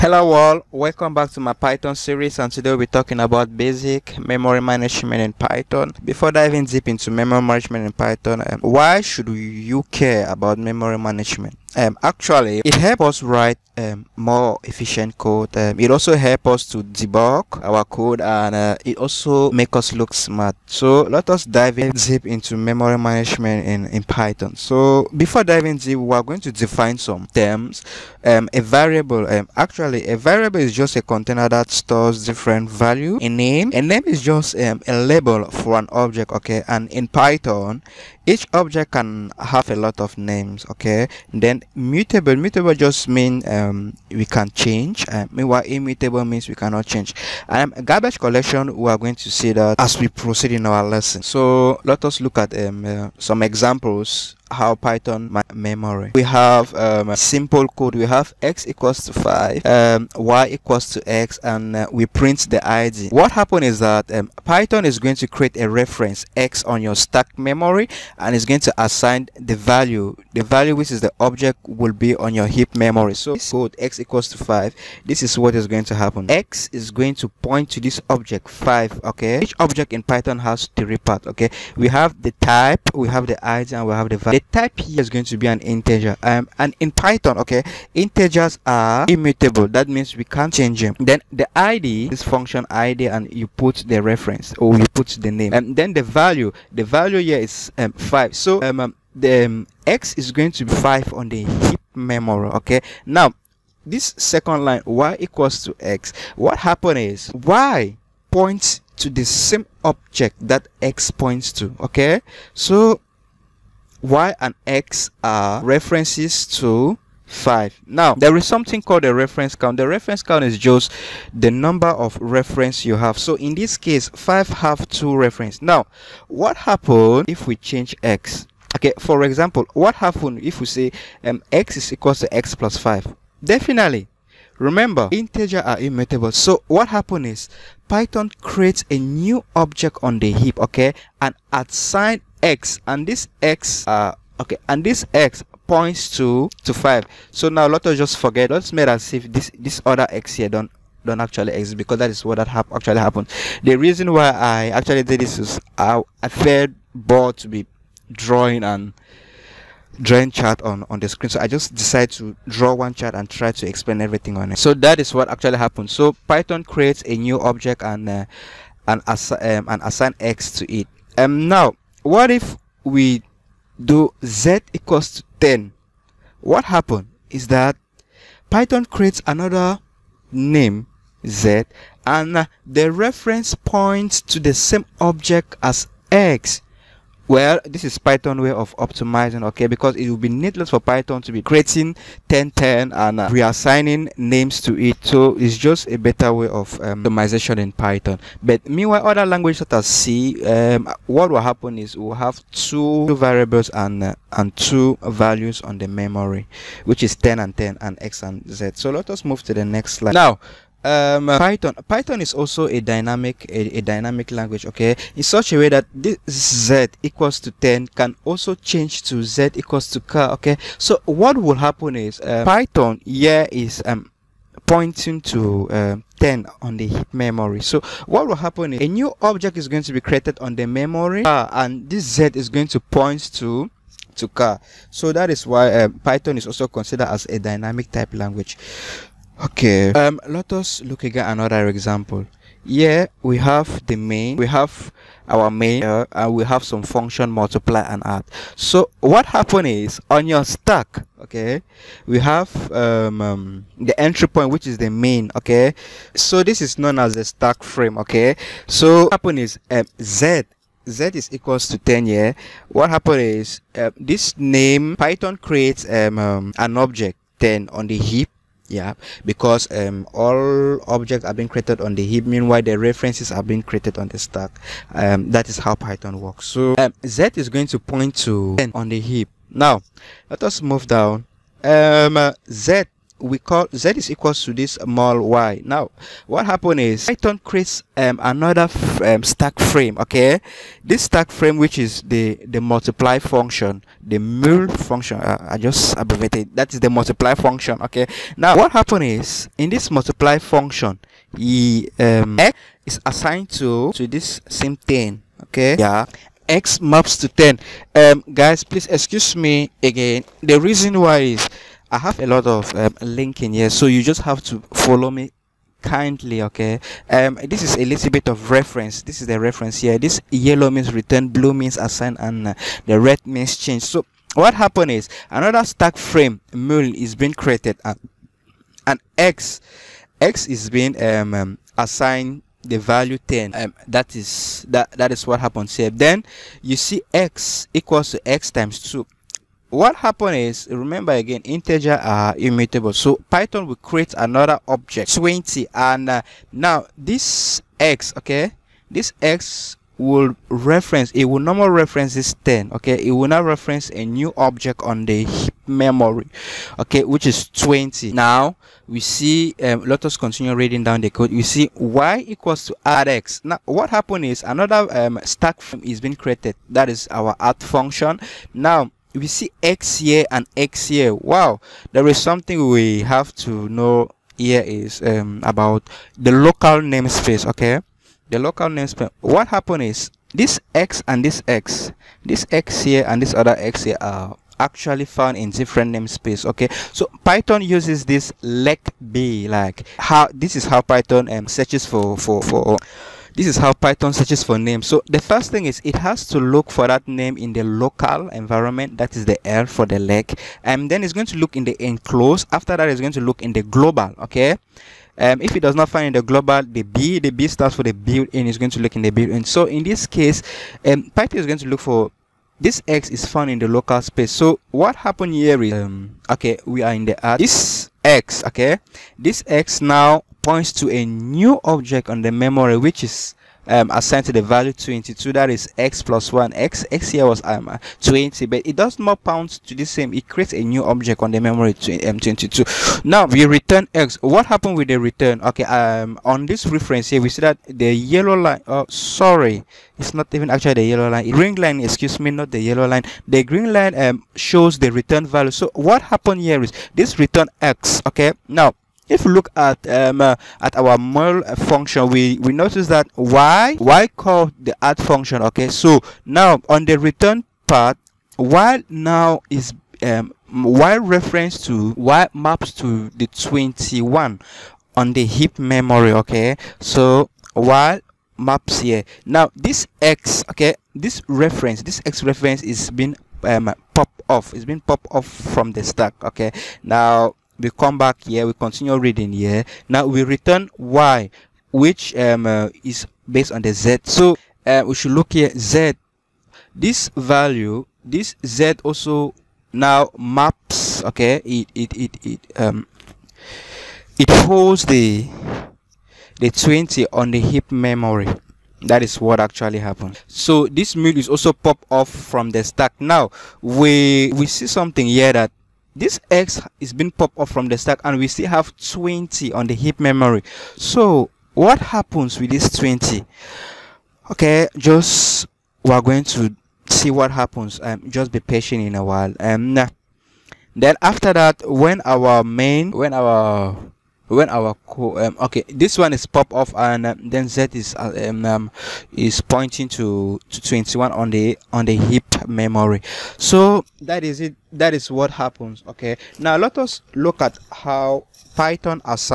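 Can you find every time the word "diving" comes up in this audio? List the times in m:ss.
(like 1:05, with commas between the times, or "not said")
0:06, 0:25.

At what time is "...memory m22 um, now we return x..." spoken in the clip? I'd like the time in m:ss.
7:11.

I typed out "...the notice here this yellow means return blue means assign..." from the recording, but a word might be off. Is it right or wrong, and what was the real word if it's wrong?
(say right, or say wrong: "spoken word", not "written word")
wrong: "reference", not "notice".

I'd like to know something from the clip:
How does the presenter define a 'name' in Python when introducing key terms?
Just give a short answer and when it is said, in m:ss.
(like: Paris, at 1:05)
a label for an object, at 0:34.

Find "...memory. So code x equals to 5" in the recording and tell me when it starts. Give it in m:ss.
1:12.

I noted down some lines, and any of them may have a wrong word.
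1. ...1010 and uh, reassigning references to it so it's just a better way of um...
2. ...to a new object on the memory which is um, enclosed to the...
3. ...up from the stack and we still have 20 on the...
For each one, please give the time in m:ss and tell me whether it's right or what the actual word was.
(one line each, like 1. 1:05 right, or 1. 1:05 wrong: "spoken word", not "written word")
1. 3:12 wrong: "names", not "references"
2. 7:00 wrong: "assigned", not "enclosed"
3. 8:27 right.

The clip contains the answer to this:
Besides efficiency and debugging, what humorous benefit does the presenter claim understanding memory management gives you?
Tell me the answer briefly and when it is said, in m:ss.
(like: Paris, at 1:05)
makes us look smart, at 0:19.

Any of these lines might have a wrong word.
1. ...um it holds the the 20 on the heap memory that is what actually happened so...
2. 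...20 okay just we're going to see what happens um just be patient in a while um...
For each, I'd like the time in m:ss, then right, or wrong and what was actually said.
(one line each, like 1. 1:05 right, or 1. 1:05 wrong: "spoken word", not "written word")
1. 8:12 right
2. 8:32 right.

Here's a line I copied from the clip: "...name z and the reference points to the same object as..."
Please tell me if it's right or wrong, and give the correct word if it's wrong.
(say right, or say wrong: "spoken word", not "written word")
right.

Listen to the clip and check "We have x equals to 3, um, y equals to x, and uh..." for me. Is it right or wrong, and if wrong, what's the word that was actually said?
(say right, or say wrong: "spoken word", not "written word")
wrong: "5", not "3".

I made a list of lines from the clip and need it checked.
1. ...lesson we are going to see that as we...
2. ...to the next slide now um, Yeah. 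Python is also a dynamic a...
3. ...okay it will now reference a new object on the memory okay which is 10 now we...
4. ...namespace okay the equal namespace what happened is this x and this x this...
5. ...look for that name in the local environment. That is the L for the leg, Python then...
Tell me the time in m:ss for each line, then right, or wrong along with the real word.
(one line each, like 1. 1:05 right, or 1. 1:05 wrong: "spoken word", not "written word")
1. 0:48 wrong: "collection", not "lesson"
2. 3:29 wrong: "Python", not "Yeah"
3. 5:52 wrong: "20", not "10"
4. 6:16 wrong: "local", not "equal"
5. 6:36 wrong: "And", not "Python".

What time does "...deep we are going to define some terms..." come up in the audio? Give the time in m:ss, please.
0:25.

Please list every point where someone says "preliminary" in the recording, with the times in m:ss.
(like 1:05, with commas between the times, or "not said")
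not said.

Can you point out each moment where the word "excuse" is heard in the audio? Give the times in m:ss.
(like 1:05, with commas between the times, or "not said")
5:08, 7:21.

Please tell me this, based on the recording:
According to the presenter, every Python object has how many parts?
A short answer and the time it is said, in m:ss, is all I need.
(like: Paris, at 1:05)
3, at 1:20.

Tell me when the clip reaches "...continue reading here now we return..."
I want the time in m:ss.
7:58.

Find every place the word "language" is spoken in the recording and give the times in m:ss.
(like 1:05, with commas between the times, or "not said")
3:19, 3:34, 3:58.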